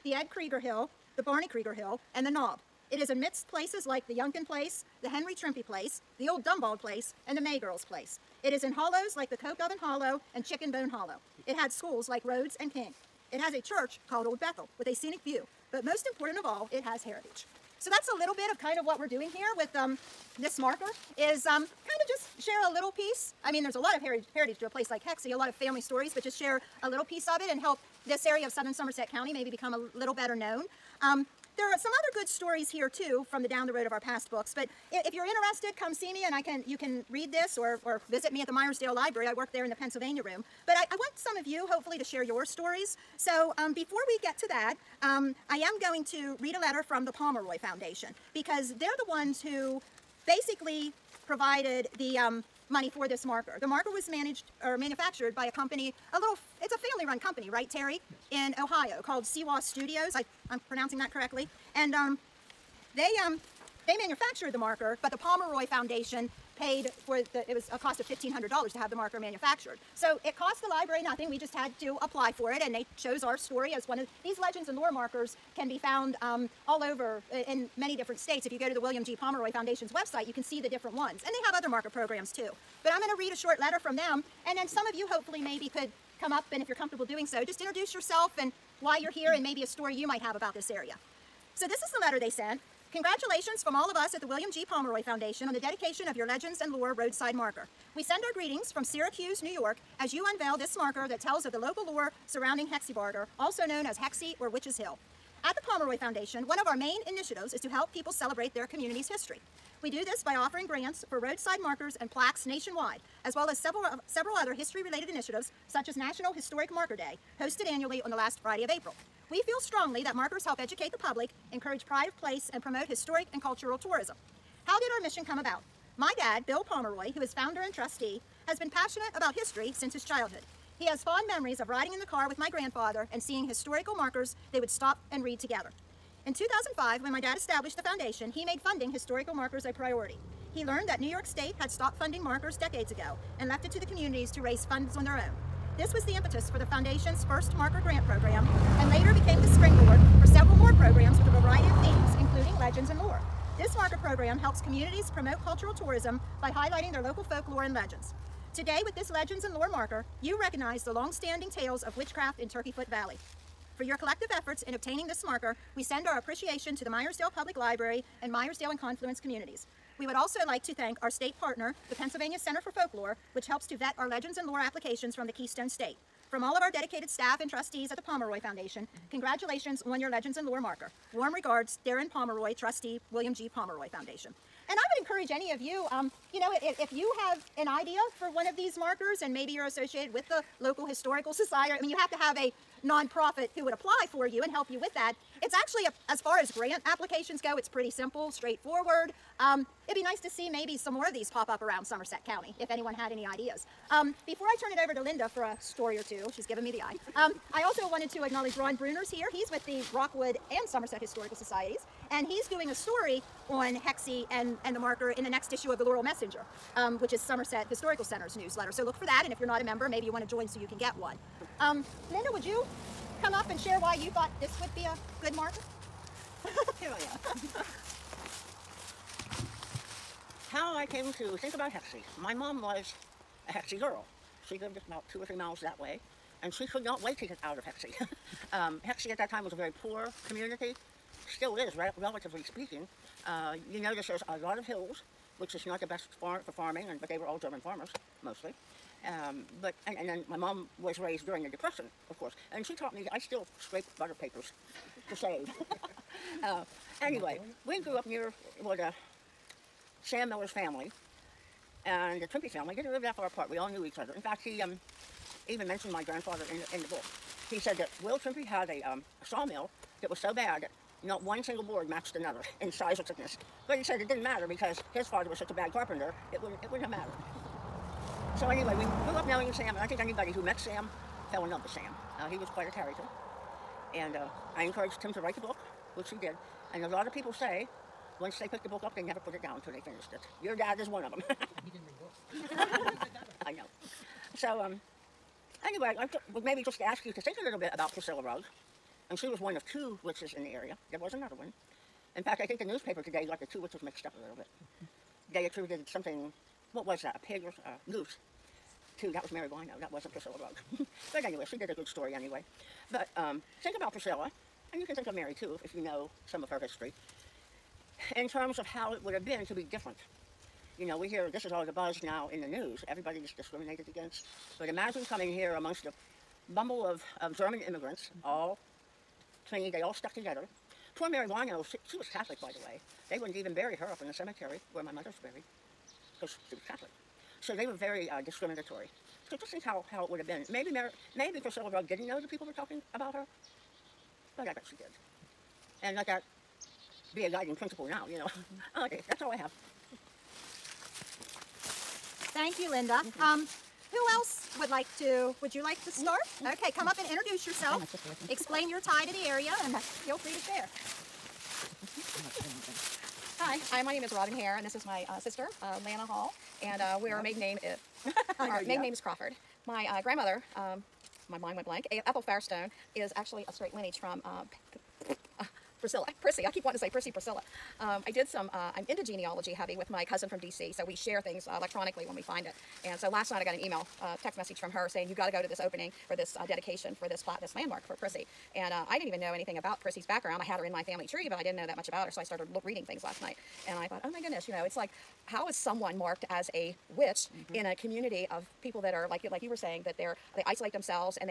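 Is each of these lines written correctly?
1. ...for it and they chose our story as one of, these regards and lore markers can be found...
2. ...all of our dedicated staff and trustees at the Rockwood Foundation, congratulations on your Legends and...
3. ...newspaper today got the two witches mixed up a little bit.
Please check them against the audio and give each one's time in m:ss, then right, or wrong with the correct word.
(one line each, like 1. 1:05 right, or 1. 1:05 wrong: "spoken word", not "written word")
1. 1:12 wrong: "legends", not "regards"
2. 2:56 wrong: "Pomeroy", not "Rockwood"
3. 5:02 right.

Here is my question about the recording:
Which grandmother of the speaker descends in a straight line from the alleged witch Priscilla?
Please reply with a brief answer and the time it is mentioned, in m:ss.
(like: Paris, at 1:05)
Ethel Firestone, at 6:12.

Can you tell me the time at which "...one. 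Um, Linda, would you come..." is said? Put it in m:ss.
3:40.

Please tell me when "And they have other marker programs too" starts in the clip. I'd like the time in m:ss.
1:21.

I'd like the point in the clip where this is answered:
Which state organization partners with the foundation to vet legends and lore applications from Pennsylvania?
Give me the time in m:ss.
2:51.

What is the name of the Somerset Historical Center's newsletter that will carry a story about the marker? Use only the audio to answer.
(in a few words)
Laurel Messenger.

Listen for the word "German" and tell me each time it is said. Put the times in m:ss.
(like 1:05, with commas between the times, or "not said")
4:07, 5:27.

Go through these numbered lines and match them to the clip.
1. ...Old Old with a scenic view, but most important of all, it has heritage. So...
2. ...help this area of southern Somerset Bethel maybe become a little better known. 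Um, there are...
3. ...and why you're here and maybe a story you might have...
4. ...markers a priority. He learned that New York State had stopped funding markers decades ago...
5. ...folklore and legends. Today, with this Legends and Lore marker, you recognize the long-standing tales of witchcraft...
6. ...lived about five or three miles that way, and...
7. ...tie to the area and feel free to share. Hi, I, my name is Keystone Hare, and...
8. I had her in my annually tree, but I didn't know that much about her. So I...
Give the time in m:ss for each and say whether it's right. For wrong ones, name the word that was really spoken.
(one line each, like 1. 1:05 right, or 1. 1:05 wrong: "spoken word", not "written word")
1. 0:14 wrong: "Bethel", not "Old"
2. 0:27 wrong: "County", not "Bethel"
3. 1:28 right
4. 2:19 right
5. 2:37 right
6. 3:54 wrong: "two", not "five"
7. 5:58 wrong: "Robin", not "Keystone"
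8. 6:30 wrong: "family", not "annually".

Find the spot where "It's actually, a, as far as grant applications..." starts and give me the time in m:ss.
3:15.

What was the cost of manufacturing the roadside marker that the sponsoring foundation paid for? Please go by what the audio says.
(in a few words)
$1,500.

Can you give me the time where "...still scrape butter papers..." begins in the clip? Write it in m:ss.
4:13.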